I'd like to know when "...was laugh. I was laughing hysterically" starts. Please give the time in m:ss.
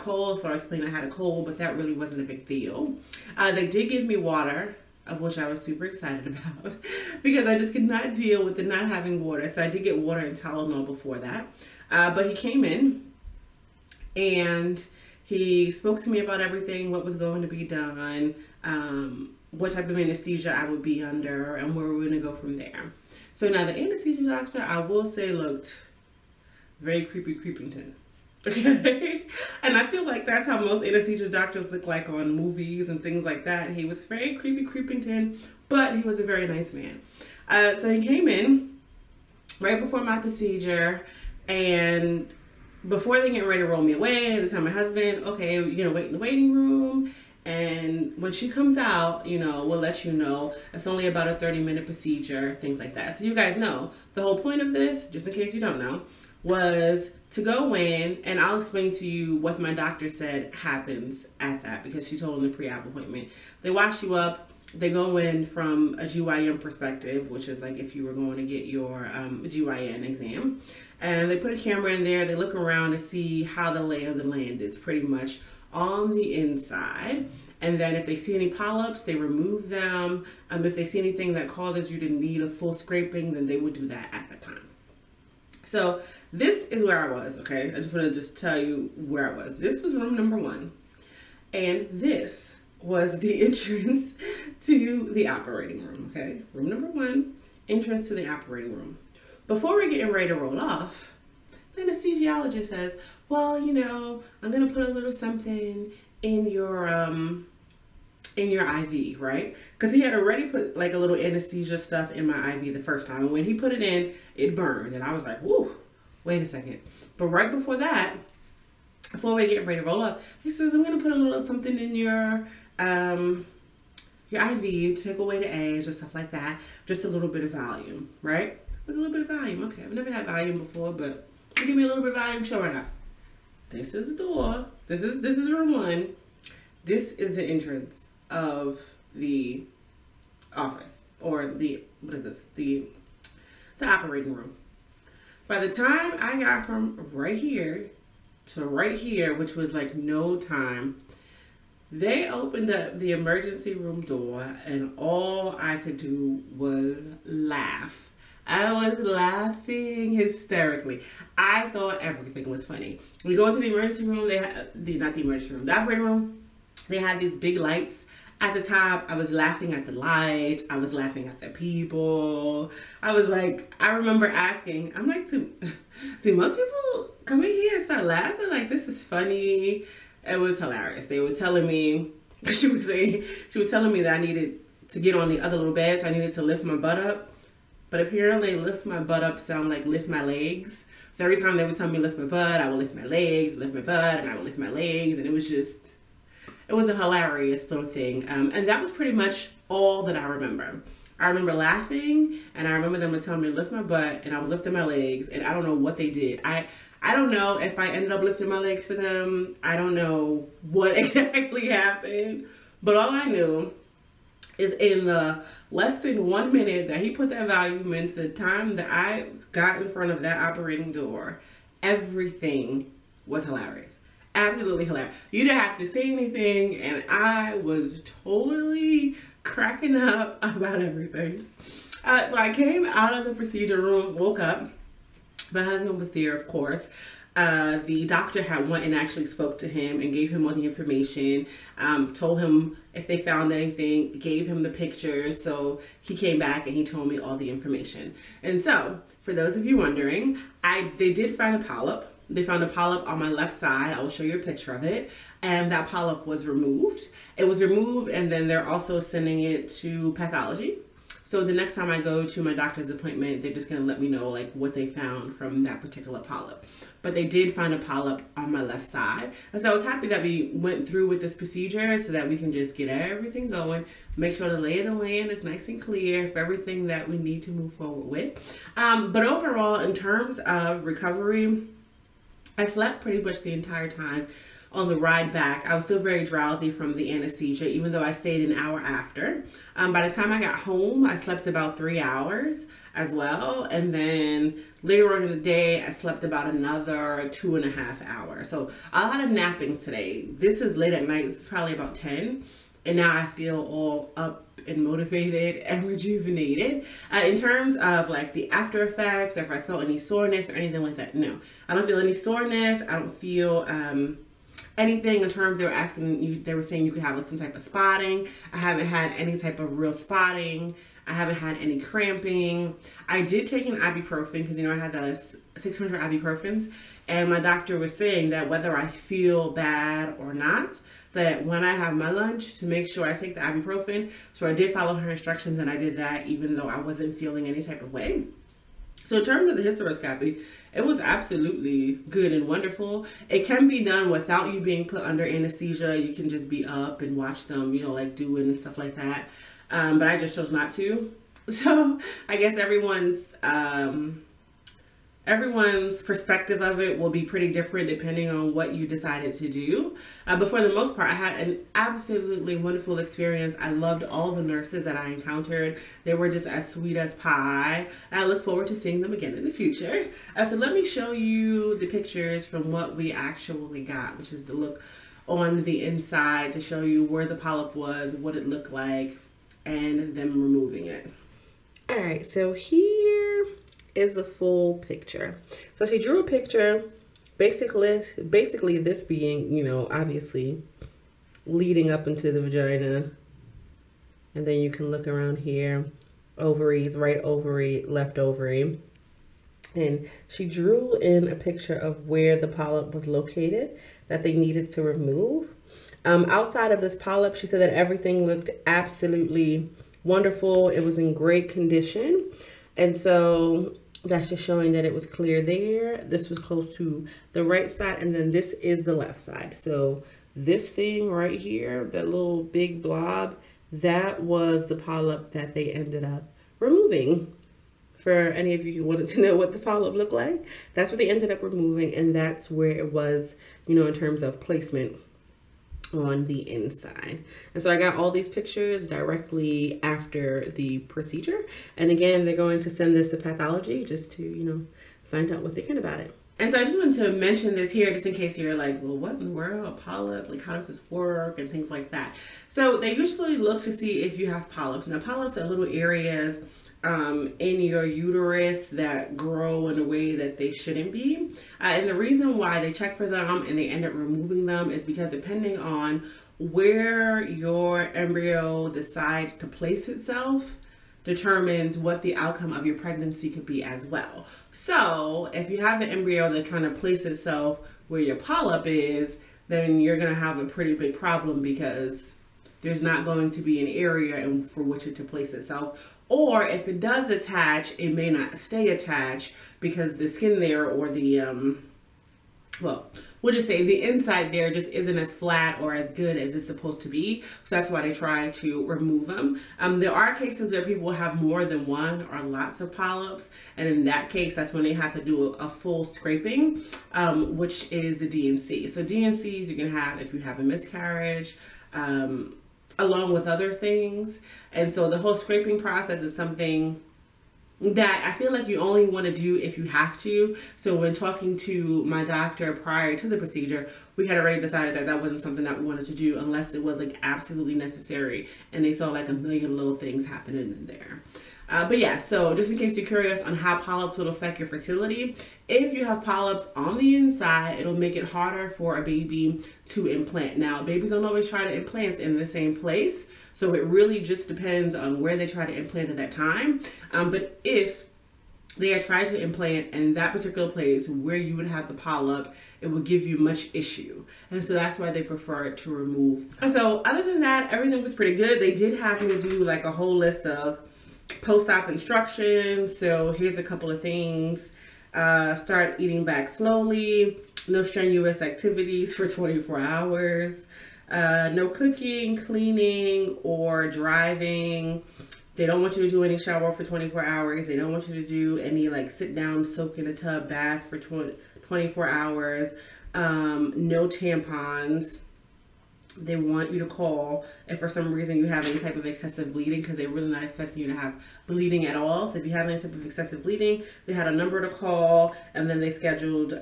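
2:36.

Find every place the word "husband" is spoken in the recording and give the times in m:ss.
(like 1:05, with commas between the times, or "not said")
0:44, 3:55.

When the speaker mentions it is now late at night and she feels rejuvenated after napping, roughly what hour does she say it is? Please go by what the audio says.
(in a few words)
about 10.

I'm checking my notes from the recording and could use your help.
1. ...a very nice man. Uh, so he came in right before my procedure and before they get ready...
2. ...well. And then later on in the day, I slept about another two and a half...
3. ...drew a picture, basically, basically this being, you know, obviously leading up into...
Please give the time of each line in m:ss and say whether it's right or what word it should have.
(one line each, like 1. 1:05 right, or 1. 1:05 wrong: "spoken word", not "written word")
1. 0:36 right
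2. 4:53 right
3. 6:26 right.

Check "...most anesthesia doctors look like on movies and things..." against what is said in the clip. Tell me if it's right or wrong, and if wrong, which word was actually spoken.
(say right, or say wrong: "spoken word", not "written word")
right.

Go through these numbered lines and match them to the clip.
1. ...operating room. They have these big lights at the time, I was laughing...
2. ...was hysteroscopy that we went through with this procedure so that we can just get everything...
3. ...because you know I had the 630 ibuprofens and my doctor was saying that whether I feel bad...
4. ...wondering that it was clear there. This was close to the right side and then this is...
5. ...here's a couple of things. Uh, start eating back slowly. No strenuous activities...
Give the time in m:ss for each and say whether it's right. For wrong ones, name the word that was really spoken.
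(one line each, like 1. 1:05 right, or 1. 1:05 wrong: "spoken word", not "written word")
1. 2:45 right
2. 4:29 wrong: "happy", not "hysteroscopy"
3. 5:24 wrong: "600", not "630"
4. 6:54 wrong: "showing", not "wondering"
5. 9:23 right.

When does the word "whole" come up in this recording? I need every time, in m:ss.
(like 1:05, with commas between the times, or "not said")
0:54, 8:34, 9:19.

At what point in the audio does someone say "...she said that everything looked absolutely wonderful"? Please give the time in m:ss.
6:47.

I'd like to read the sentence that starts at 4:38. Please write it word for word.
Um, but overall, in terms of recovery, I slept pretty much the entire time on the ride back.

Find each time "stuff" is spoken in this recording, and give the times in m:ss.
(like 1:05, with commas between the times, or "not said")
1:51, 2:05, 5:48.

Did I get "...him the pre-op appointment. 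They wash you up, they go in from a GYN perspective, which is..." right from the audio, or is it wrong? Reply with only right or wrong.
right.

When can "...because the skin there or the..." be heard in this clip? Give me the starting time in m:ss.
8:09.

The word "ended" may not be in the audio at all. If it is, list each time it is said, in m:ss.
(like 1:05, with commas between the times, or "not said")
3:27, 7:05, 7:11.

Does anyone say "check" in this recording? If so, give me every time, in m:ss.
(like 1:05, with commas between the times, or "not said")
7:42.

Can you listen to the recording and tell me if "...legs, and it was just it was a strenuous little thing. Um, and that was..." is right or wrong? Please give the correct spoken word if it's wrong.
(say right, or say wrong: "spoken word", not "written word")
wrong: "hilarious", not "strenuous".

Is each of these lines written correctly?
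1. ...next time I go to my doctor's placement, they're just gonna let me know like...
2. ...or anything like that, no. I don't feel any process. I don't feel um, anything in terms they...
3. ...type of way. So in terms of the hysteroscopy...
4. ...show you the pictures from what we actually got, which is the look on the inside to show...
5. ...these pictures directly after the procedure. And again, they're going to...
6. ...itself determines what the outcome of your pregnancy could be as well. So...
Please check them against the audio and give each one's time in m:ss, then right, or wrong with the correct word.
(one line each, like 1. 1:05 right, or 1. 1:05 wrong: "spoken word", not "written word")
1. 4:21 wrong: "appointment", not "placement"
2. 5:10 wrong: "soreness", not "process"
3. 5:37 right
4. 6:10 right
5. 7:18 right
6. 7:49 right.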